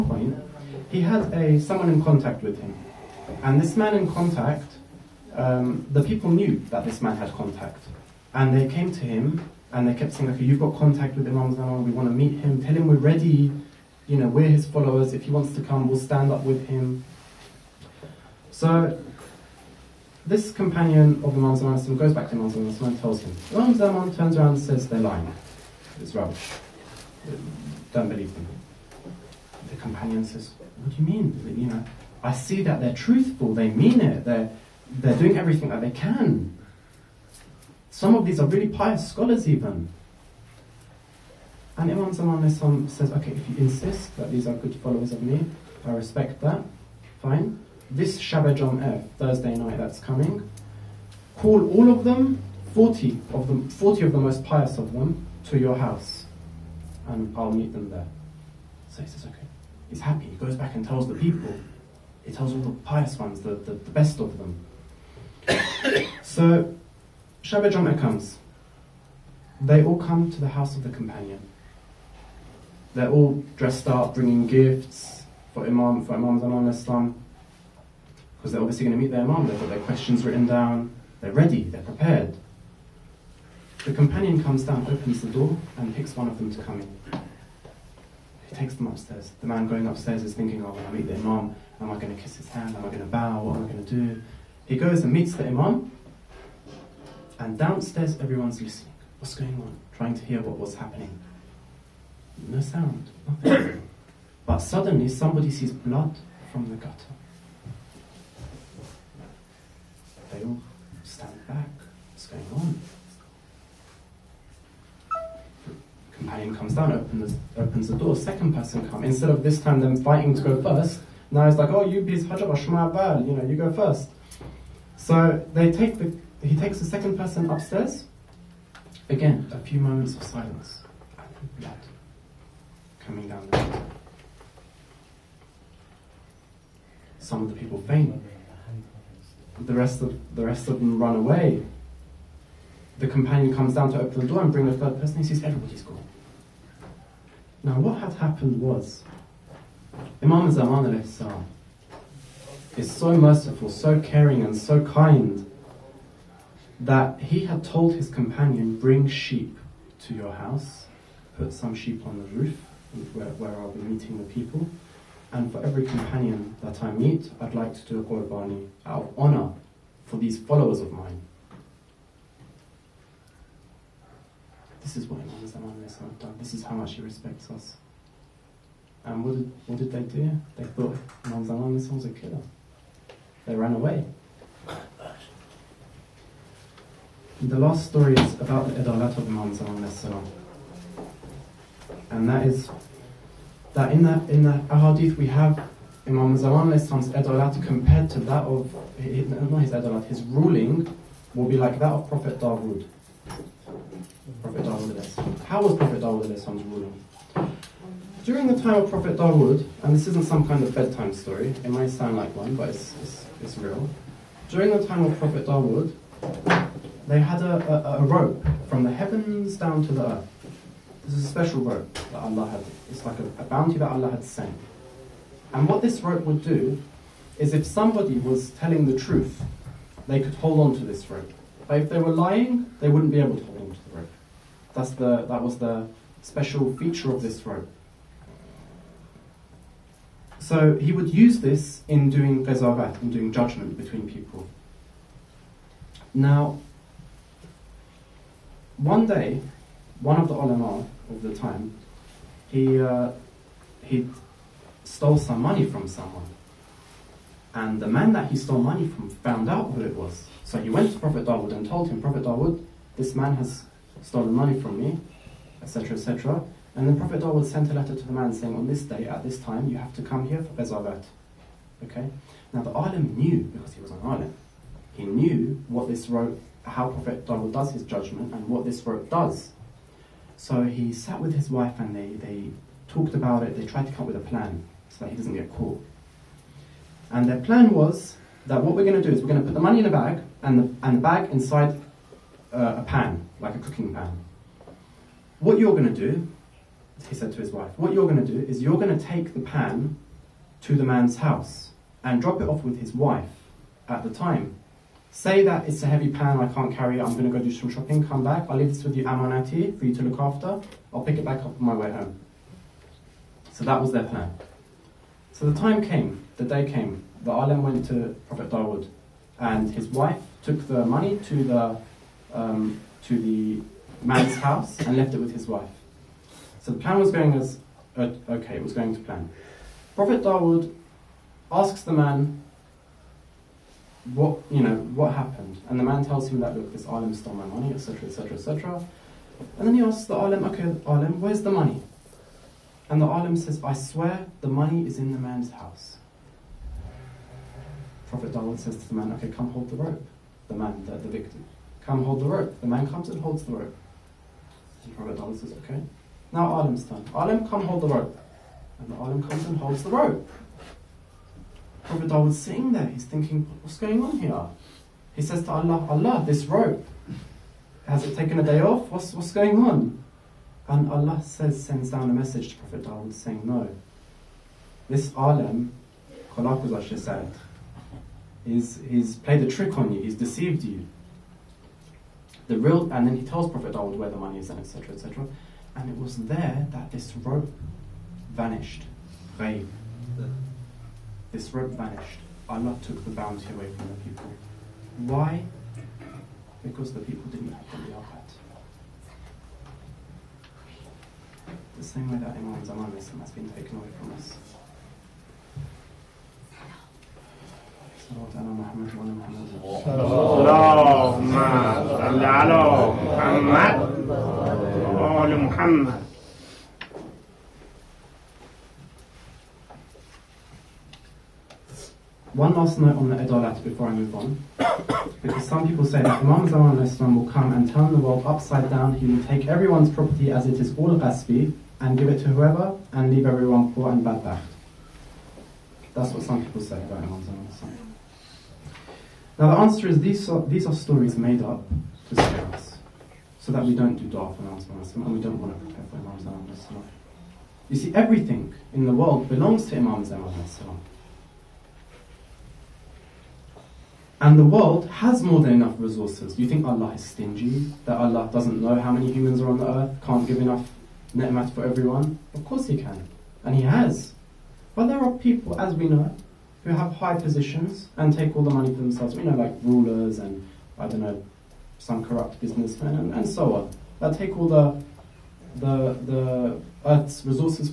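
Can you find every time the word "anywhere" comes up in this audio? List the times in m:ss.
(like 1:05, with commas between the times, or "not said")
not said.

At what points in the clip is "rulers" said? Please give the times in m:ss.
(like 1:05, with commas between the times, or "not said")
7:49.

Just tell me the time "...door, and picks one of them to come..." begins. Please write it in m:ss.
1:25.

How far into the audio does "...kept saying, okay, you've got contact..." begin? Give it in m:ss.
0:09.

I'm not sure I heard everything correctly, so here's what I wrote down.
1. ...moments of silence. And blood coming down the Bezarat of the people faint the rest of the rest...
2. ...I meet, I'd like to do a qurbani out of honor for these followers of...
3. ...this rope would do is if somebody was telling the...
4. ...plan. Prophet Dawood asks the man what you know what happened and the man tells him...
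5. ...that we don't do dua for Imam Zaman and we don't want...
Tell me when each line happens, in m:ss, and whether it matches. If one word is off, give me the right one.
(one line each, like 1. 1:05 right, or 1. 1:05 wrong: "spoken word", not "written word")
1. 2:09 wrong: "Some", not "Bezarat"
2. 2:46 right
3. 3:45 right
4. 5:29 right
5. 7:23 right.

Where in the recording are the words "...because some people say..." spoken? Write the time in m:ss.
7:05.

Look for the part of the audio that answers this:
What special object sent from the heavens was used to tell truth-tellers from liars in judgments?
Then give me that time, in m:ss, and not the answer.
3:38.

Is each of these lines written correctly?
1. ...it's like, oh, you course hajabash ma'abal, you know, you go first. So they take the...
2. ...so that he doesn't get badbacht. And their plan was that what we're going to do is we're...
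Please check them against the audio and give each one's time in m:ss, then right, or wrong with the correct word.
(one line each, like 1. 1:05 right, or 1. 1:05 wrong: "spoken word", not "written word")
1. 2:01 wrong: "please", not "course"
2. 4:44 wrong: "caught", not "badbacht".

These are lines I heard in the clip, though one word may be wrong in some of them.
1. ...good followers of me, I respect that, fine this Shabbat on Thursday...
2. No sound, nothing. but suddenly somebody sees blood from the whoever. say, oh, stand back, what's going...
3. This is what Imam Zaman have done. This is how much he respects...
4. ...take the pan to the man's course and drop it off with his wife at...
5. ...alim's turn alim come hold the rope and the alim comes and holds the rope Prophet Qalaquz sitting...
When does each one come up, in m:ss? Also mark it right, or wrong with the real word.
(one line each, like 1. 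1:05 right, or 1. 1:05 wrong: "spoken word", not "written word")
1. 0:44 right
2. 1:42 wrong: "gutter", not "whoever"
3. 2:54 right
4. 4:59 wrong: "house", not "course"
5. 5:56 wrong: "Dawood", not "Qalaquz".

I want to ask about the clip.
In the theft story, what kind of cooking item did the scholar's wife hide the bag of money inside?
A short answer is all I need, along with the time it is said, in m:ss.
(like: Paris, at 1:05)
A cooking pan, at 4:53.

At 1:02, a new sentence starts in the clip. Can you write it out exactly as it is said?
He tells all the pious ones, the, the, the best of them.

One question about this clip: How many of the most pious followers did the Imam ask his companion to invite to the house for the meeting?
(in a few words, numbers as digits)
40.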